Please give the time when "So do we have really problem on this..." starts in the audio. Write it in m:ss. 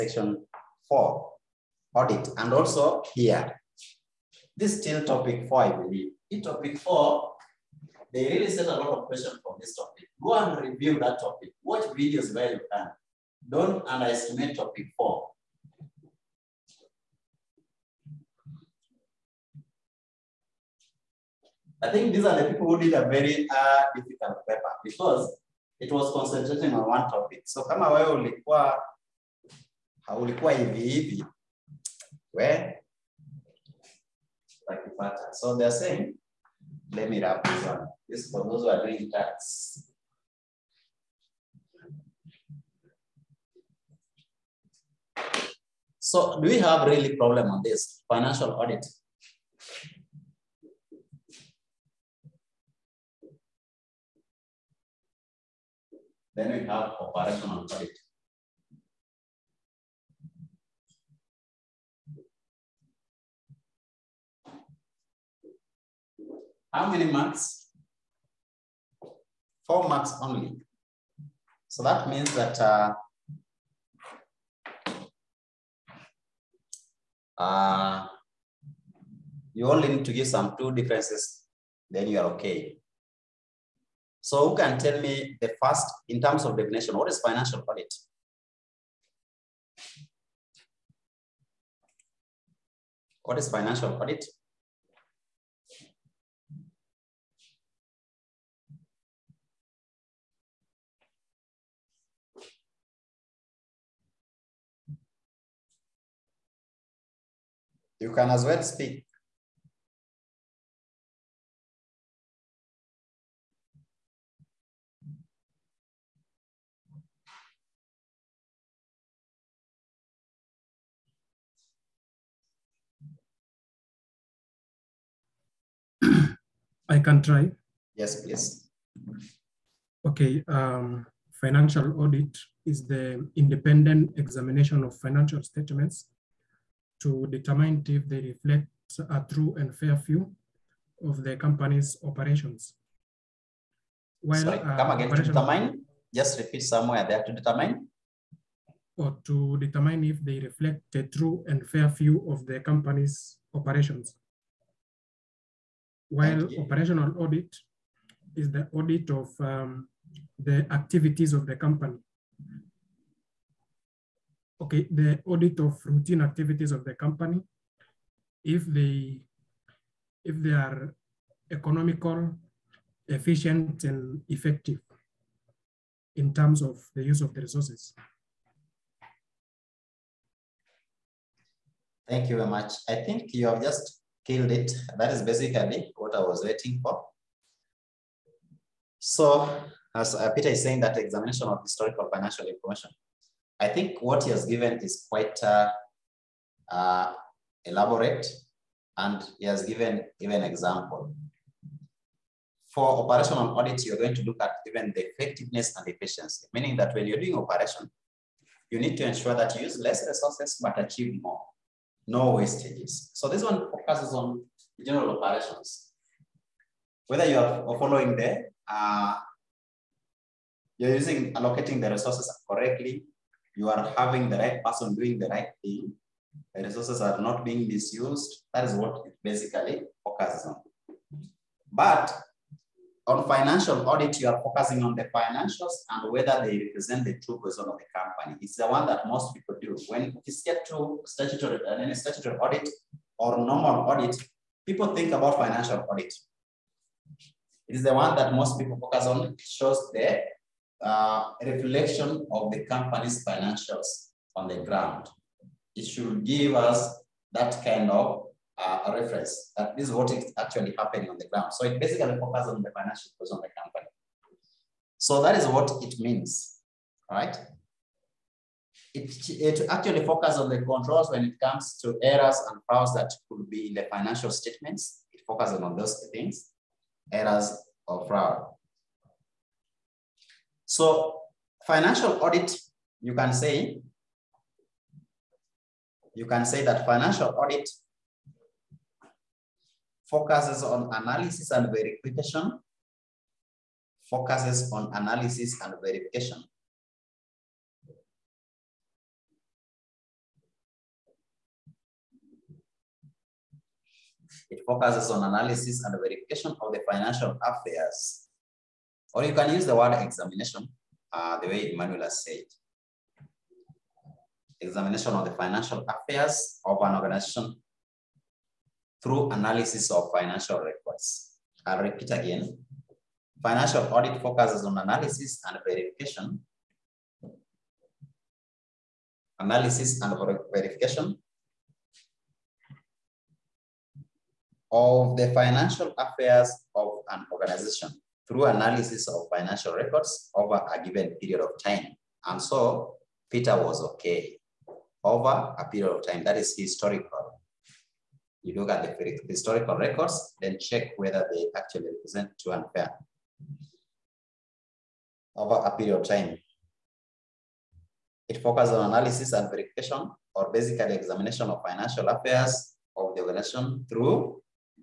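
0:45.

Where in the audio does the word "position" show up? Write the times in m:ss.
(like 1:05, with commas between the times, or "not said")
4:23.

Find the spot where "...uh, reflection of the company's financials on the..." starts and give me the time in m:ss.
4:10.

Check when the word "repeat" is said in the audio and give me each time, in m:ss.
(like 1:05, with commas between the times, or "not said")
2:26, 5:21.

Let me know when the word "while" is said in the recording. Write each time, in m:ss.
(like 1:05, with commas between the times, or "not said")
2:24, 2:36.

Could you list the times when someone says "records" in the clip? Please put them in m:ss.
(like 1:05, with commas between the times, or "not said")
5:20, 5:39, 5:49.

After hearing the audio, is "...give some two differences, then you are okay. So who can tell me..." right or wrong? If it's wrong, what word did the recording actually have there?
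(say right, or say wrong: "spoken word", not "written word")
right.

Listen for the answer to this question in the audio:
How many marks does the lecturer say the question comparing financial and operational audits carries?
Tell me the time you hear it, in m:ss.
1:09.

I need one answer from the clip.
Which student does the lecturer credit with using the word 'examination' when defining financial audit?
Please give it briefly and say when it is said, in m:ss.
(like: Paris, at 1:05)
Emmanuel, at 5:11.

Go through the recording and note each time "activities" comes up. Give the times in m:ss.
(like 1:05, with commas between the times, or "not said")
2:40, 2:46.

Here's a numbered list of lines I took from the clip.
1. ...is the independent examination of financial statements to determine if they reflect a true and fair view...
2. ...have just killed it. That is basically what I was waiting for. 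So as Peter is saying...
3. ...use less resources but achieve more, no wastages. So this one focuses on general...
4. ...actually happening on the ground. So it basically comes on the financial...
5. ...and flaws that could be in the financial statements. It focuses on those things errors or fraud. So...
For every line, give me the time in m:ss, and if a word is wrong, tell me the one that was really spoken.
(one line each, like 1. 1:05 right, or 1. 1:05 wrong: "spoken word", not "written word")
1. 2:12 right
2. 3:03 right
3. 3:29 right
4. 4:20 wrong: "focuses", not "comes"
5. 4:32 right.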